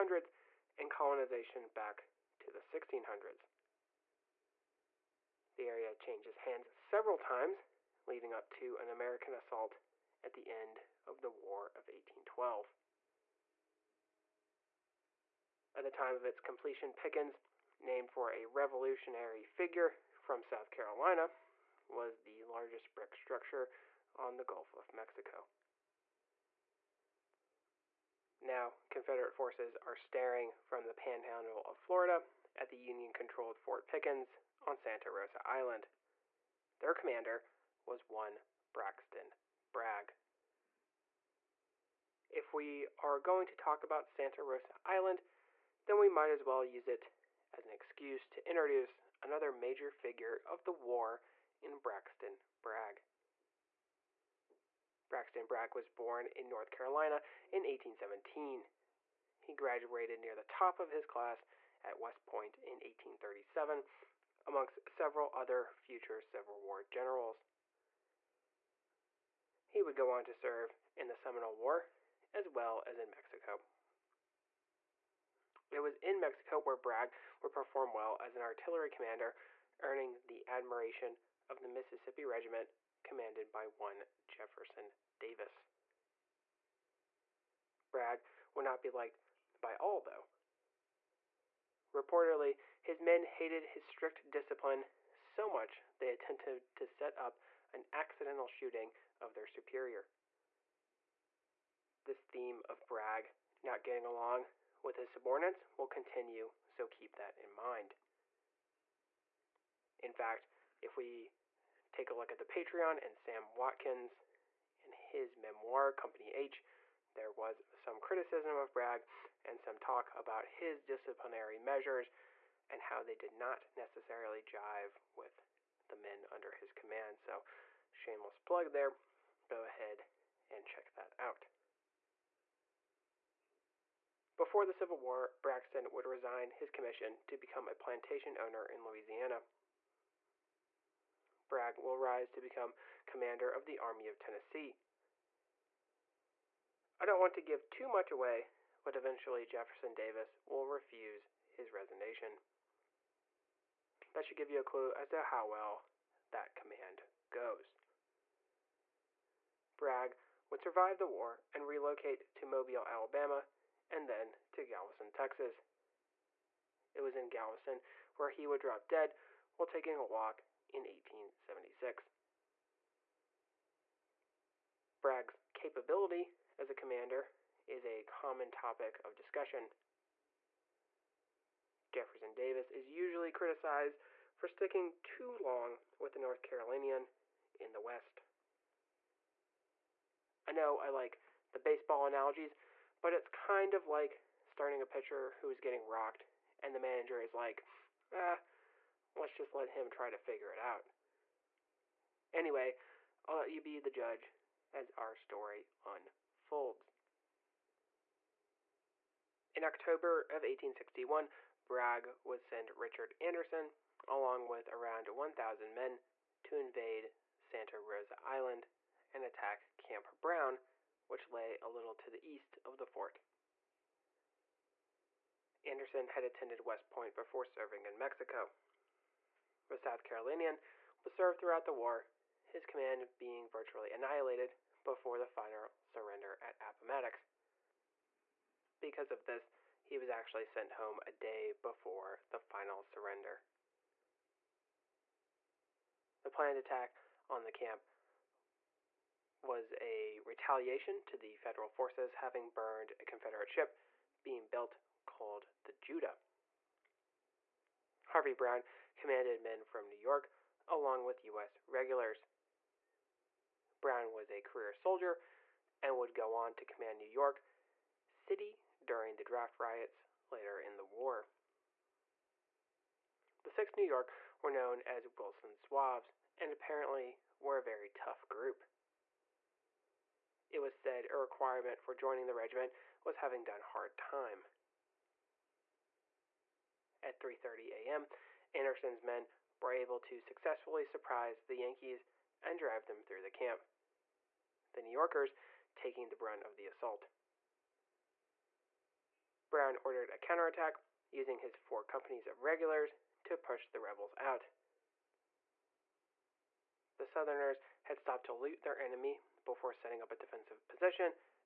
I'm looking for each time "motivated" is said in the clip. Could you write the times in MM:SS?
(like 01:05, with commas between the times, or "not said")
not said.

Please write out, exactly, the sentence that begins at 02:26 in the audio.
I don't want to give too much away, but eventually Jefferson Davis will refuse his resignation.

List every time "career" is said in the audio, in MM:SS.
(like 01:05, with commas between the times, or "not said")
04:24.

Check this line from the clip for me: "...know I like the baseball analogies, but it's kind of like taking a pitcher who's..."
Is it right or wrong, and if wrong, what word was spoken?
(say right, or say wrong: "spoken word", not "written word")
wrong: "starting", not "taking".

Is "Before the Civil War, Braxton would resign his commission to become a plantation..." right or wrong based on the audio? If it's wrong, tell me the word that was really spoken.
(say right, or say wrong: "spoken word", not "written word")
right.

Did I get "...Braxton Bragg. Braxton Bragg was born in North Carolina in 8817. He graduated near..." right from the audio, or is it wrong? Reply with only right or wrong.
wrong.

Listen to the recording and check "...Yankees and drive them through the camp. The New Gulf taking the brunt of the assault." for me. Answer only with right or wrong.
wrong.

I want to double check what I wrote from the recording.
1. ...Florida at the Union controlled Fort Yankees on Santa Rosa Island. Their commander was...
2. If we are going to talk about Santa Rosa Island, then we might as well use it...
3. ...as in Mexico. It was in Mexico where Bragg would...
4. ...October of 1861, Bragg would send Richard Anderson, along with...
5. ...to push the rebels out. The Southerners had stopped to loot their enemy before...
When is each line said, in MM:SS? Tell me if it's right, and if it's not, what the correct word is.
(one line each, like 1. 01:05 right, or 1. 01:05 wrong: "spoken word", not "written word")
1. 00:31 wrong: "Pickens", not "Yankees"
2. 00:42 right
3. 01:12 right
4. 03:29 right
5. 05:03 right.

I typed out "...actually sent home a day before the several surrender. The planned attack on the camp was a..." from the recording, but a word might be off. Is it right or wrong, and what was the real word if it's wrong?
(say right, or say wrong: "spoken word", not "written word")
wrong: "final", not "several".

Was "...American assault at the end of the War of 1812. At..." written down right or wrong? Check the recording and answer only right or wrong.
right.